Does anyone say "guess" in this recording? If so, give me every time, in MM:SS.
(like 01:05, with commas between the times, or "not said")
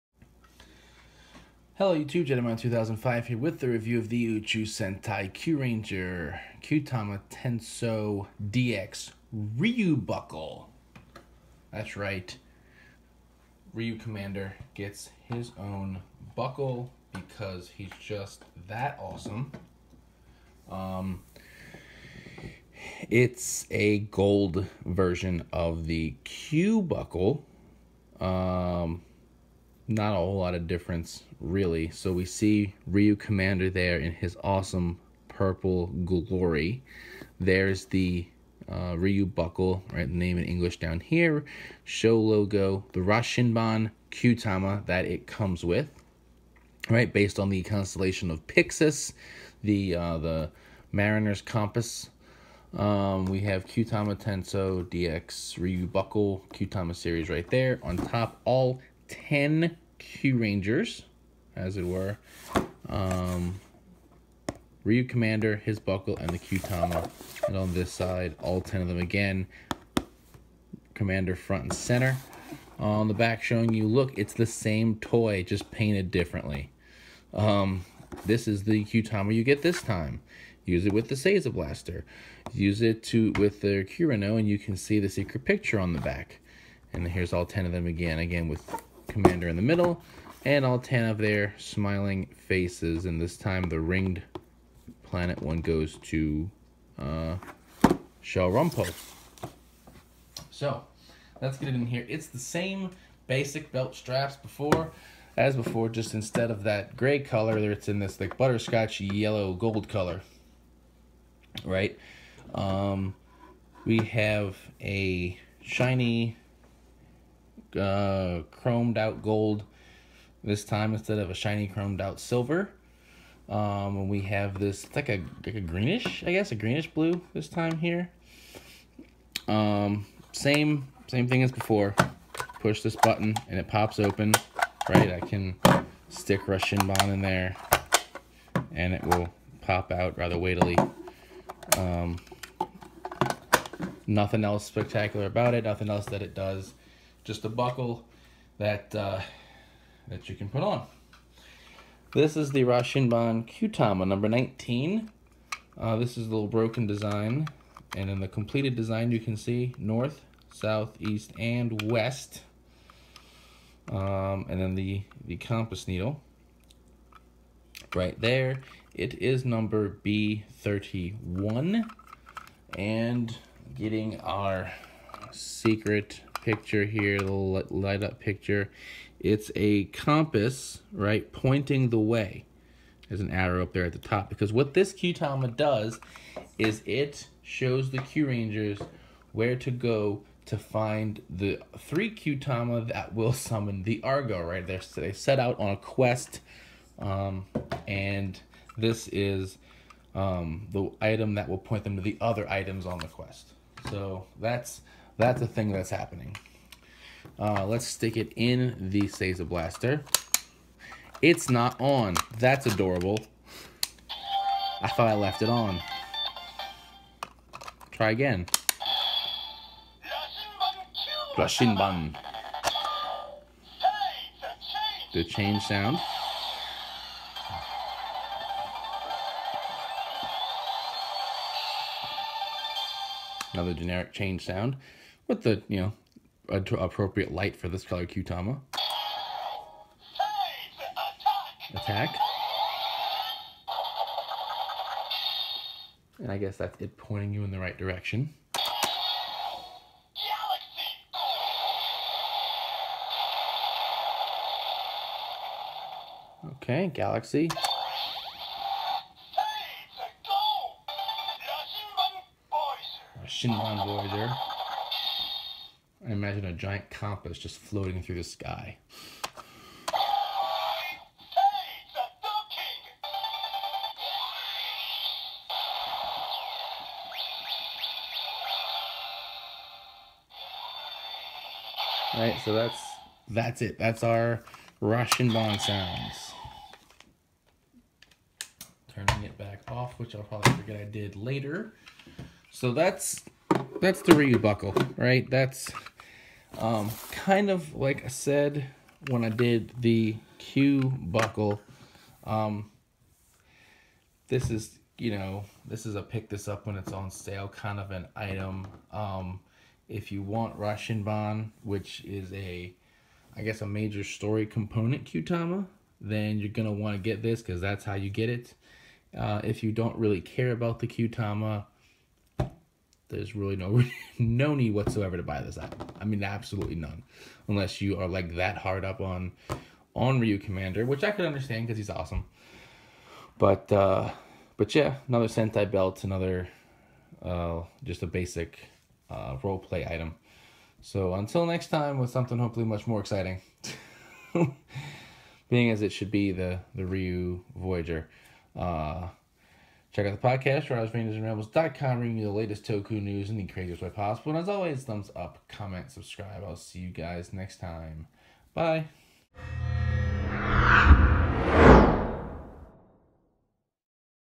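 02:06, 04:06, 05:13.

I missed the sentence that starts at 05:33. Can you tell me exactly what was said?
But uh, but yeah, another Sentai belt, another uh, just a basic uh, role play item.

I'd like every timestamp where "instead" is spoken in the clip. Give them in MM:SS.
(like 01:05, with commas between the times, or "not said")
01:46, 02:00.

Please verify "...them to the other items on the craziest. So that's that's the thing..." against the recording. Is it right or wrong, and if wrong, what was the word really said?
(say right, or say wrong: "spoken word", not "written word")
wrong: "quest", not "craziest".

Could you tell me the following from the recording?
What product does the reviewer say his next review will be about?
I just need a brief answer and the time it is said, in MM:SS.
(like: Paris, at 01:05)
Ryu Voyager, at 05:46.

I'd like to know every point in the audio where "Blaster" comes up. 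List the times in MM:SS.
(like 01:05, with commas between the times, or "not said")
01:21, 03:29.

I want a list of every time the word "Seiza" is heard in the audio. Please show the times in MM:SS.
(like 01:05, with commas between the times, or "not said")
01:21, 03:29.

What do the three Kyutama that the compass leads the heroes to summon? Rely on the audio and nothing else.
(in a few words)
The Argo.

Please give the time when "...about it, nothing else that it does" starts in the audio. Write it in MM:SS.
02:25.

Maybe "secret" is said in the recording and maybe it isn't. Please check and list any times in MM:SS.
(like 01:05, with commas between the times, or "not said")
01:25, 02:55.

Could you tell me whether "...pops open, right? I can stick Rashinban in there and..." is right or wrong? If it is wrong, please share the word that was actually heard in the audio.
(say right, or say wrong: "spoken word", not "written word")
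right.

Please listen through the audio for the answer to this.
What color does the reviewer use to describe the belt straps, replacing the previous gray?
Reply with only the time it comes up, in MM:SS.
01:48.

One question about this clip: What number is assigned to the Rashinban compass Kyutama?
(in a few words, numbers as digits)
19.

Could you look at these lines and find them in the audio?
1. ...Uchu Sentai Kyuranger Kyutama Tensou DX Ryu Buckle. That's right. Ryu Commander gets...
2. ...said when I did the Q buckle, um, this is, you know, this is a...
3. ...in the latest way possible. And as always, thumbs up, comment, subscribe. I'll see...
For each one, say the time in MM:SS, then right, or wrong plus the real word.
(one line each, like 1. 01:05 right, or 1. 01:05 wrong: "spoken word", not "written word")
1. 00:04 right
2. 04:58 right
3. 05:53 wrong: "craziest", not "latest".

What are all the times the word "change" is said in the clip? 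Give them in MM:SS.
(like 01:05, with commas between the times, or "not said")
03:45, 03:54.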